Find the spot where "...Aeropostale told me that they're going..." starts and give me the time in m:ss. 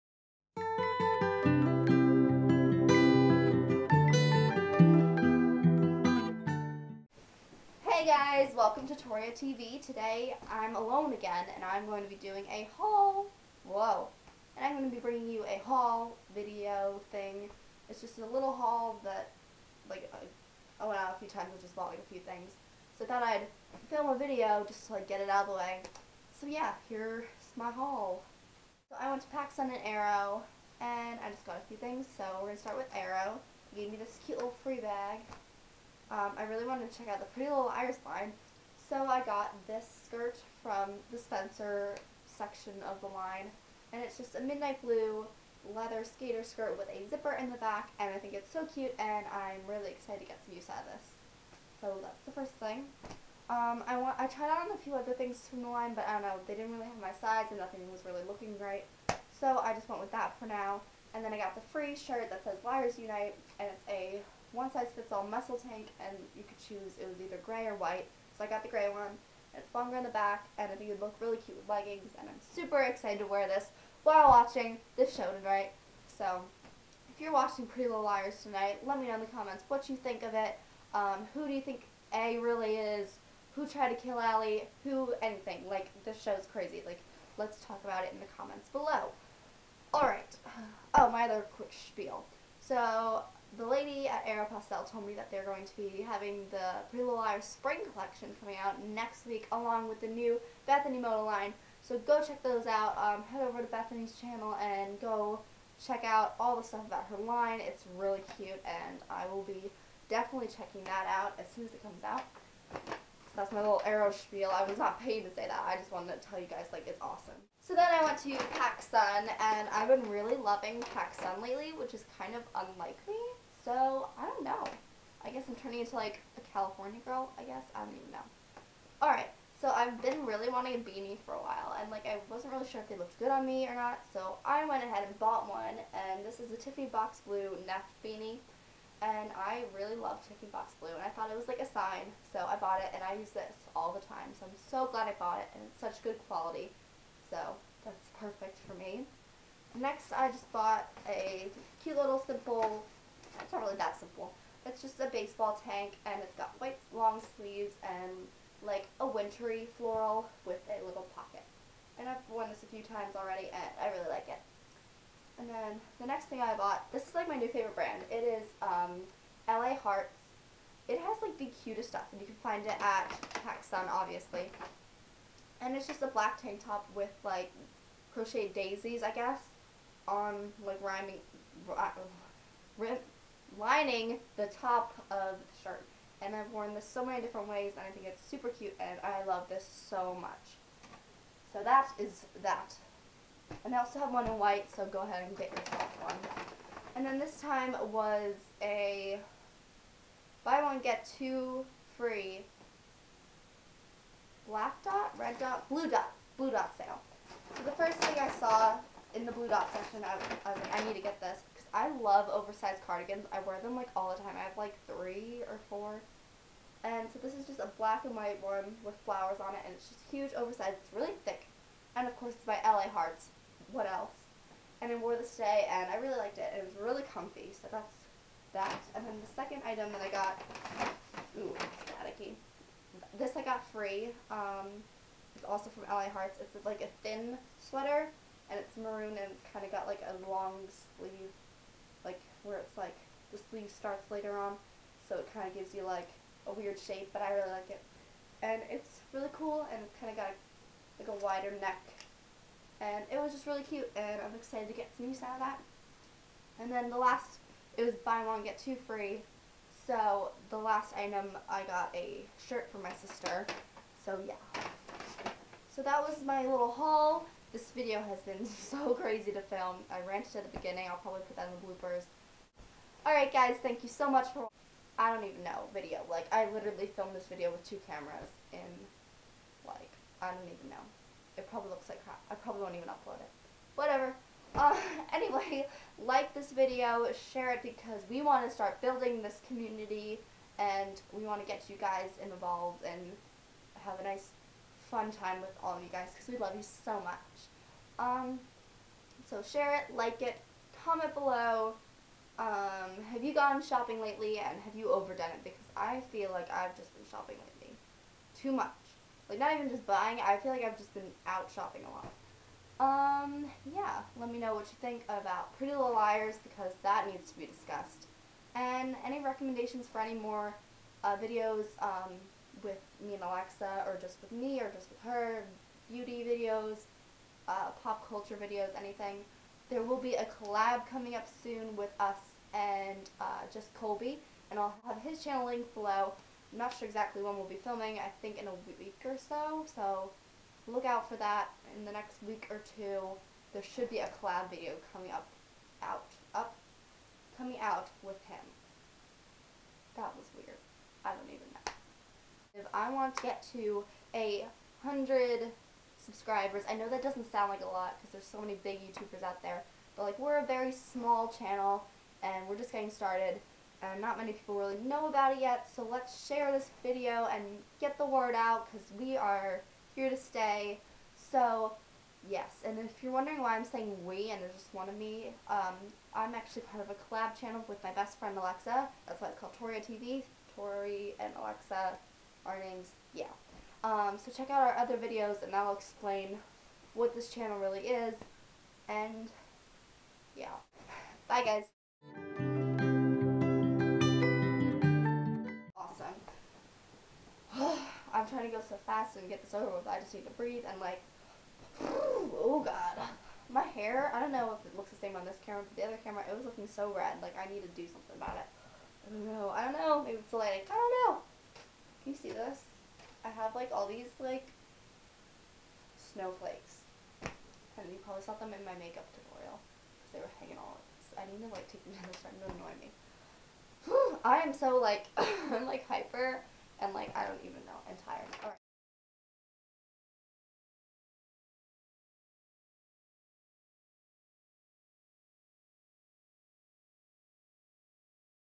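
1:34.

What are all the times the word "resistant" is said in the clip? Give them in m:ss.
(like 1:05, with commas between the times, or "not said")
not said.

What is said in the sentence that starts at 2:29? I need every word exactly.
Next, I just bought a cute little simple it's not really that simple.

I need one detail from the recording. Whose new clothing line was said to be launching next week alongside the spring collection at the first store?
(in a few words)
Bethany Mota.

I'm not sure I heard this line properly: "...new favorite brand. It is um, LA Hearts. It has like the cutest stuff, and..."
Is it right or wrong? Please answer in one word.
right.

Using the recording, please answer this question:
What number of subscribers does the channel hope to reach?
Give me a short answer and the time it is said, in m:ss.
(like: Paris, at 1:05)
100, at 5:54.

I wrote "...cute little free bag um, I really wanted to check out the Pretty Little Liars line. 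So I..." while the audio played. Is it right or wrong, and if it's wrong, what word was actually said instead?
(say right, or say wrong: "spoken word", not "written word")
right.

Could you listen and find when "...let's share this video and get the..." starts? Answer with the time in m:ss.
6:05.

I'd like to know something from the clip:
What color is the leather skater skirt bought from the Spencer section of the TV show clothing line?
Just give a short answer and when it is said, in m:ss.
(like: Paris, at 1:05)
Midnight blue, at 0:44.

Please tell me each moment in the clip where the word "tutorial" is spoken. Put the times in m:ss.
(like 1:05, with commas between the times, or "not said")
6:59.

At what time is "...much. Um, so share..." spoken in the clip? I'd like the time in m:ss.
4:57.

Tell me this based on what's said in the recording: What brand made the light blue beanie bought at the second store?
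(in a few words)
Neff.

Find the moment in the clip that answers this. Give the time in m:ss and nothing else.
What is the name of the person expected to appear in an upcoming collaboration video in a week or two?
5:33.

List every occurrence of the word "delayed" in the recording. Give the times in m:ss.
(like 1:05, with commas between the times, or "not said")
not said.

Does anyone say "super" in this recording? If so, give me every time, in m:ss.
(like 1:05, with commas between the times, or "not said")
1:12, 3:08.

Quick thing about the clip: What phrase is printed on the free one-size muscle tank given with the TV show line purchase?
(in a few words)
Liars Unite.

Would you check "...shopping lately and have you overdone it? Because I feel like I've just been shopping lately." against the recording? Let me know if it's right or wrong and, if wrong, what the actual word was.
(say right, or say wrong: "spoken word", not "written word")
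right.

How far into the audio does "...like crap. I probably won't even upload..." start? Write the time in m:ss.
4:41.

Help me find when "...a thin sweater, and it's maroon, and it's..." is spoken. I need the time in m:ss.
3:56.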